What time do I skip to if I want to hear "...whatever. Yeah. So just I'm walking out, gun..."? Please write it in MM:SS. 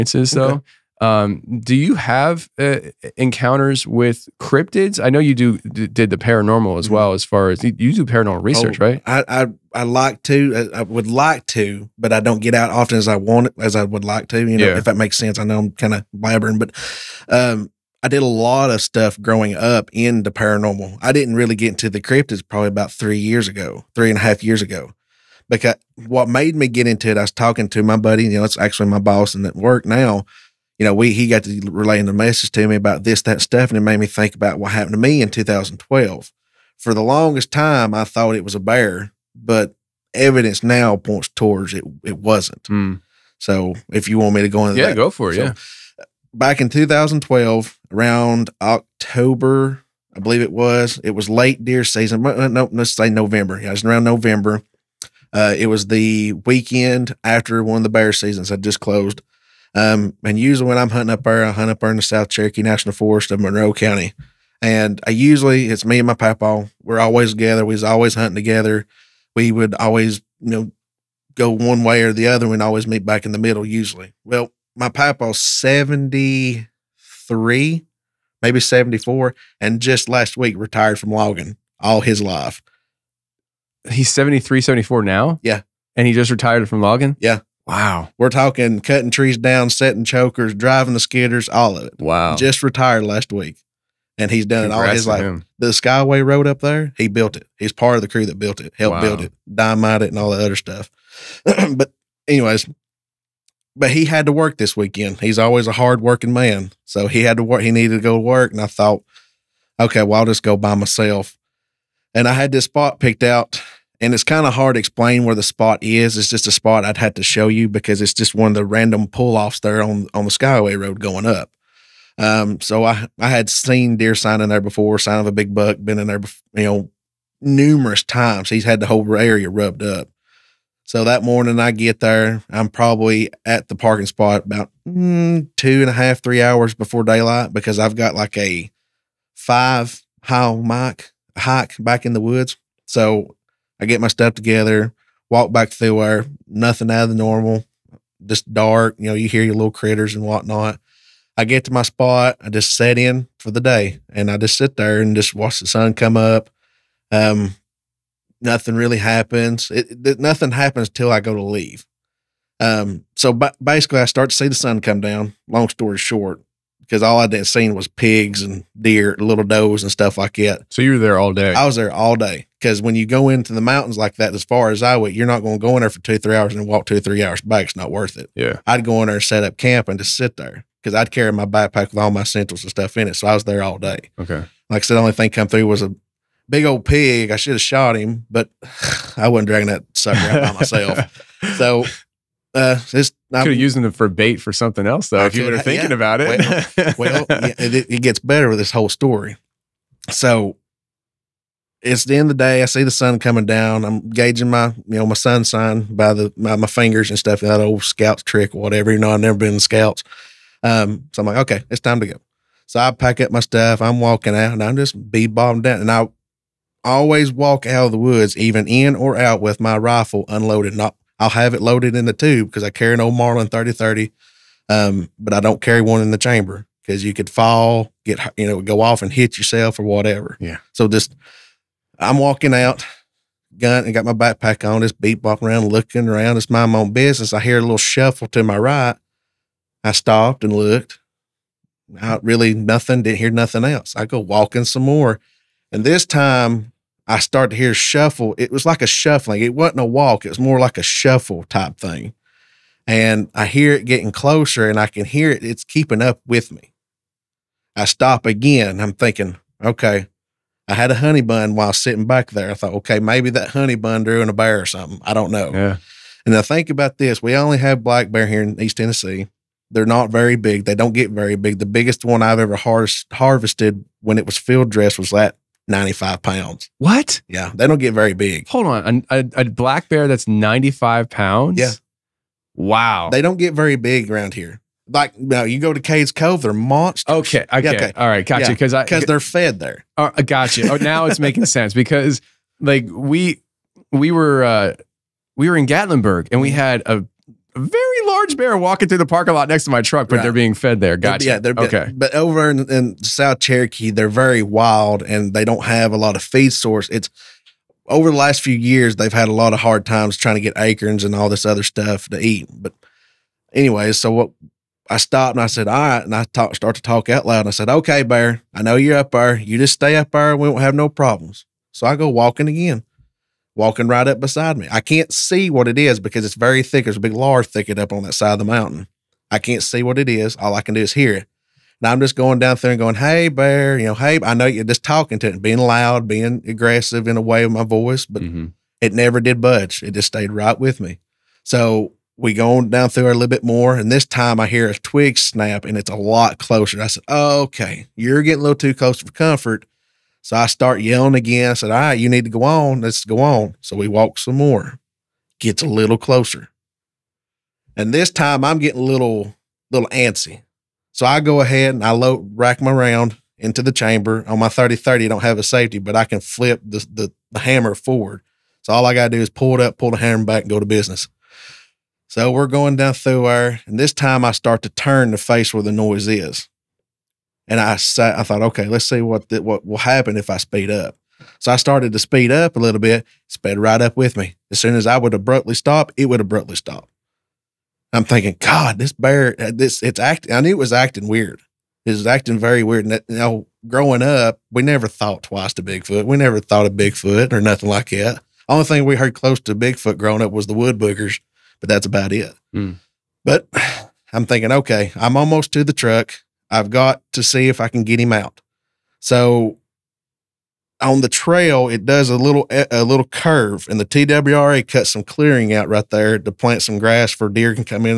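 03:49.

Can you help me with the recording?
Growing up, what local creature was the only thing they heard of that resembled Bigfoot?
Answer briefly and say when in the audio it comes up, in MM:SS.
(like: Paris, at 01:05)
wood boogers, at 06:40.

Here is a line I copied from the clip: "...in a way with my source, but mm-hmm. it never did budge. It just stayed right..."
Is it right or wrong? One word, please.
wrong.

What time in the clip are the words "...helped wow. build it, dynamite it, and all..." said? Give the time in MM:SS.
01:38.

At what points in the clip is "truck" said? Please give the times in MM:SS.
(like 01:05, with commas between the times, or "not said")
04:59, 06:45.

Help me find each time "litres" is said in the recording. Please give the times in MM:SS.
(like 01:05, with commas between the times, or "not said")
not said.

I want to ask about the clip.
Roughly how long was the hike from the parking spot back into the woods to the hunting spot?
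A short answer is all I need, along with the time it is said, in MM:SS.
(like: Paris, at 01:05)
5 miles, at 02:19.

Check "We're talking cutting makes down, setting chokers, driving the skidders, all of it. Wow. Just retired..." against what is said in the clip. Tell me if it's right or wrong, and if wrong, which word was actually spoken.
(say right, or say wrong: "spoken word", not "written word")
wrong: "trees", not "makes".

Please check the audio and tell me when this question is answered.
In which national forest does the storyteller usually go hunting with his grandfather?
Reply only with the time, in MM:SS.
01:02.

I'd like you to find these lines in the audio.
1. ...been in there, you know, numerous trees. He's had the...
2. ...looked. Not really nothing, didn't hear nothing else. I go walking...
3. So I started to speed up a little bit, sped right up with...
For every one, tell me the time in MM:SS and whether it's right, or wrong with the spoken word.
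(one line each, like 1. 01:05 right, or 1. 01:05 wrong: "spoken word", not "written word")
1. 02:05 wrong: "times", not "trees"
2. 04:00 right
3. 06:21 right.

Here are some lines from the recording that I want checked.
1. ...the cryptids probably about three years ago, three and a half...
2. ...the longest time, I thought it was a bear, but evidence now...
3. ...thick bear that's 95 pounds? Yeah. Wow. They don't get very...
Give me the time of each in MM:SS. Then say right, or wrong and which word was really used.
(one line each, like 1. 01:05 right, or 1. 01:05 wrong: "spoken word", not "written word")
1. 00:21 right
2. 00:36 right
3. 04:39 wrong: "black", not "thick".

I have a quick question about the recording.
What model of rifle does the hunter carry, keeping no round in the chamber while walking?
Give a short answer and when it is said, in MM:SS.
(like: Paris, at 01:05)
Marlin 30-30, at 03:42.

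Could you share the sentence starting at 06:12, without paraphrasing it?
So we're going down through there.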